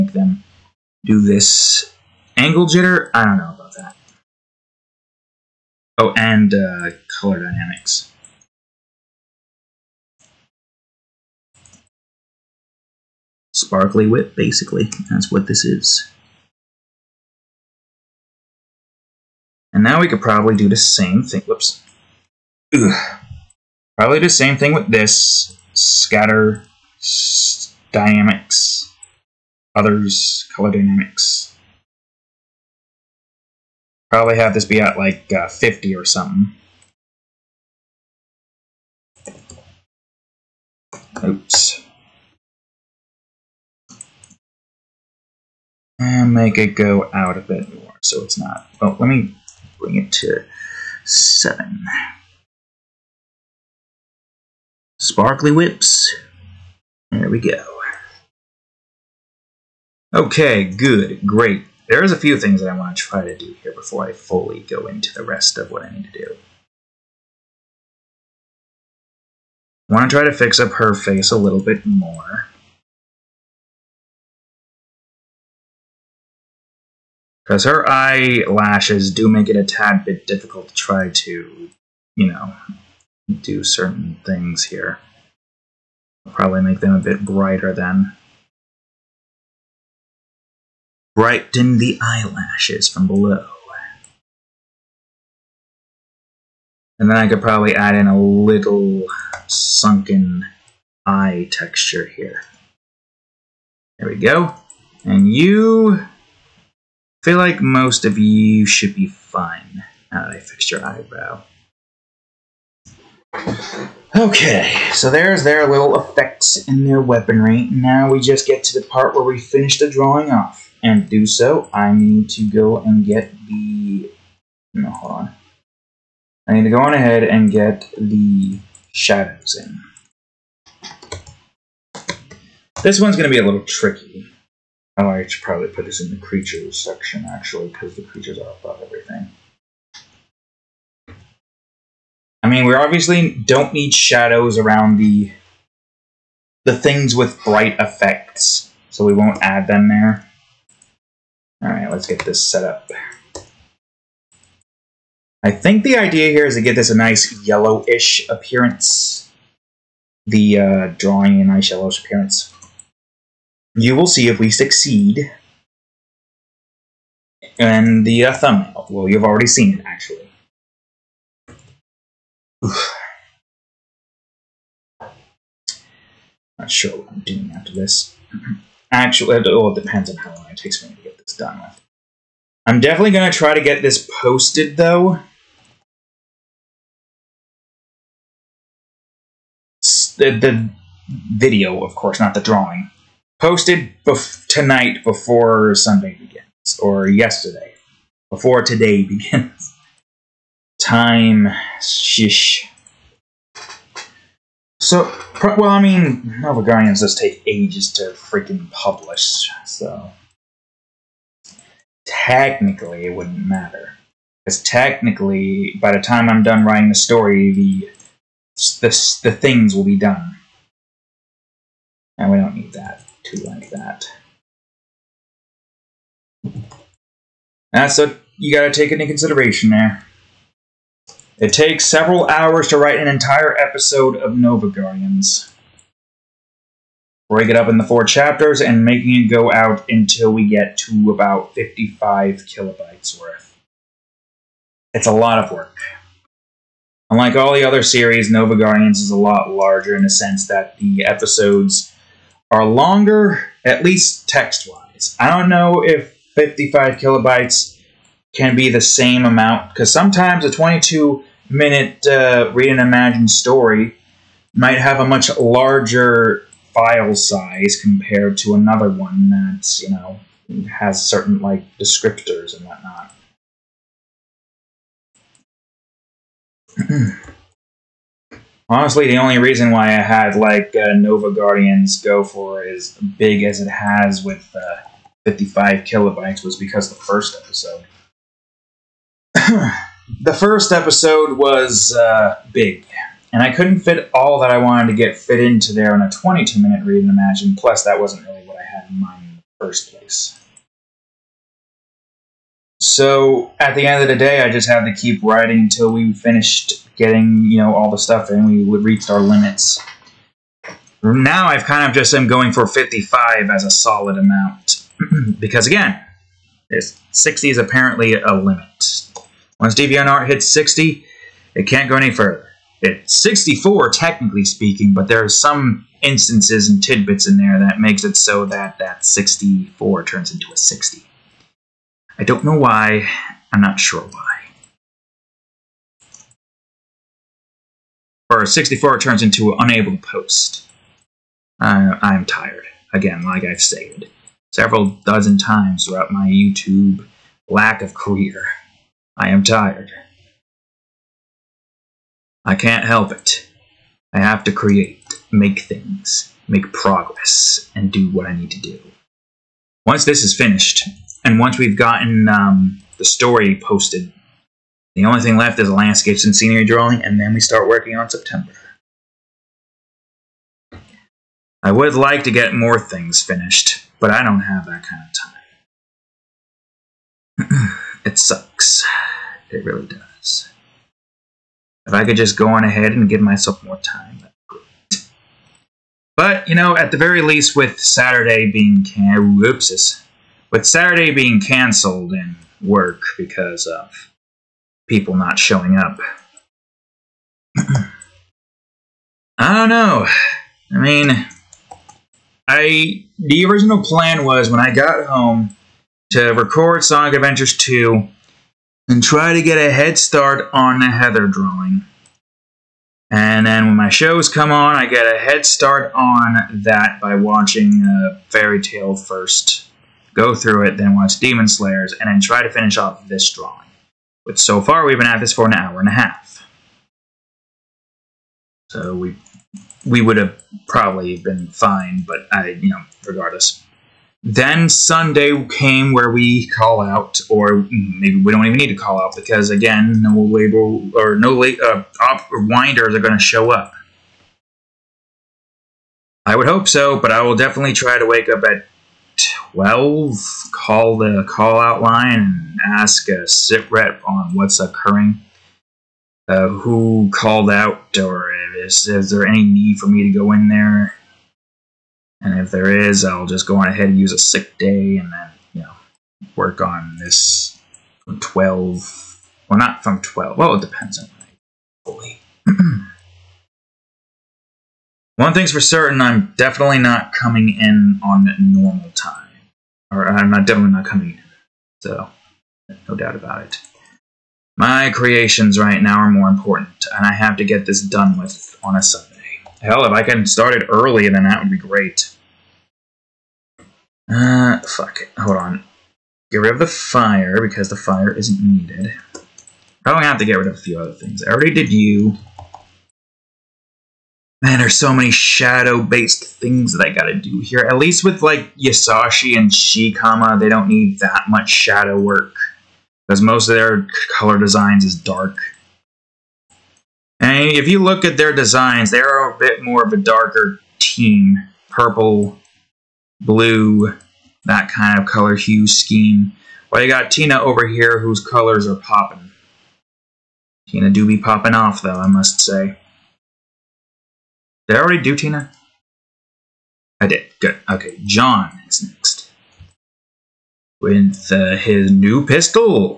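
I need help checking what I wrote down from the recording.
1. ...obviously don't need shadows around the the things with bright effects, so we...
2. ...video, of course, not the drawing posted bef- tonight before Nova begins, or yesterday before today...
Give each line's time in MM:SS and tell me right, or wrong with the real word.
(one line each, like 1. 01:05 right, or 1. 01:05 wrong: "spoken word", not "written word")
1. 02:22 right
2. 03:11 wrong: "Sunday", not "Nova".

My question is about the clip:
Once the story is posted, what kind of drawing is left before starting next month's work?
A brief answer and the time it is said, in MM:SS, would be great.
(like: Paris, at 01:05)
Landscapes and scenery, at 06:05.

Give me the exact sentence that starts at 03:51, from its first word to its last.
It takes several hours to write an entire episode of Nova Guardians.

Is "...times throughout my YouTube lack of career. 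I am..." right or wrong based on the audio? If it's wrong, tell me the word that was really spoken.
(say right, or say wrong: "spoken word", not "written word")
right.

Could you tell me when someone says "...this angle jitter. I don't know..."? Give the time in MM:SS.
00:01.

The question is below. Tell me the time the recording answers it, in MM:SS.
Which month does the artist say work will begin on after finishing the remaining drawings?
06:08.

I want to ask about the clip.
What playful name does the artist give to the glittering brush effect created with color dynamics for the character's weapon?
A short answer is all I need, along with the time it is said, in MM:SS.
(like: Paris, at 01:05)
Sparkly whip, at 00:13.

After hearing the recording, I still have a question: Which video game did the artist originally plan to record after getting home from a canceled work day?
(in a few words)
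Sonic Adventures 2.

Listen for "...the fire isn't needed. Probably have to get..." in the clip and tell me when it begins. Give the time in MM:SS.
08:17.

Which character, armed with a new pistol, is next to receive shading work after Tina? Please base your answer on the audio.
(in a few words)
John.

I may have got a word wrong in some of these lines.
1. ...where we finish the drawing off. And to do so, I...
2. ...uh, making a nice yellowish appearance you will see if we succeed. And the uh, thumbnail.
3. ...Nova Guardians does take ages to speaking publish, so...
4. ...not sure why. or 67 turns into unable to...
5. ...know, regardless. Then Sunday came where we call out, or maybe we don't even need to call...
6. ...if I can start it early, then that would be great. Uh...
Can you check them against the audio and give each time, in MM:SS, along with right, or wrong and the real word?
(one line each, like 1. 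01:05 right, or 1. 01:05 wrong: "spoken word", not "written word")
1. 01:59 right
2. 02:40 wrong: "drawing", not "making"
3. 03:26 wrong: "freaking", not "speaking"
4. 05:33 wrong: "64", not "67"
5. 07:12 right
6. 08:09 right.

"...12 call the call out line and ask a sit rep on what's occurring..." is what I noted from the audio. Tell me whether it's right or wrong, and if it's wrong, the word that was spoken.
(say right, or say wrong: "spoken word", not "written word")
right.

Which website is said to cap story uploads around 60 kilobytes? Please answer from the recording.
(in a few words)
DeviantArt.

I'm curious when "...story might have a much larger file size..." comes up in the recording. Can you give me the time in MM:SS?
04:23.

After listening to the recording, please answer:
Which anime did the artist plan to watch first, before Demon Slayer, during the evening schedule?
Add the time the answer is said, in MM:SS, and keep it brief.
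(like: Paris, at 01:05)
Fairy Tale, at 06:58.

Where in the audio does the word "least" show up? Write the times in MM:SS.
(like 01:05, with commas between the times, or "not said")
04:13, 06:27, 08:27.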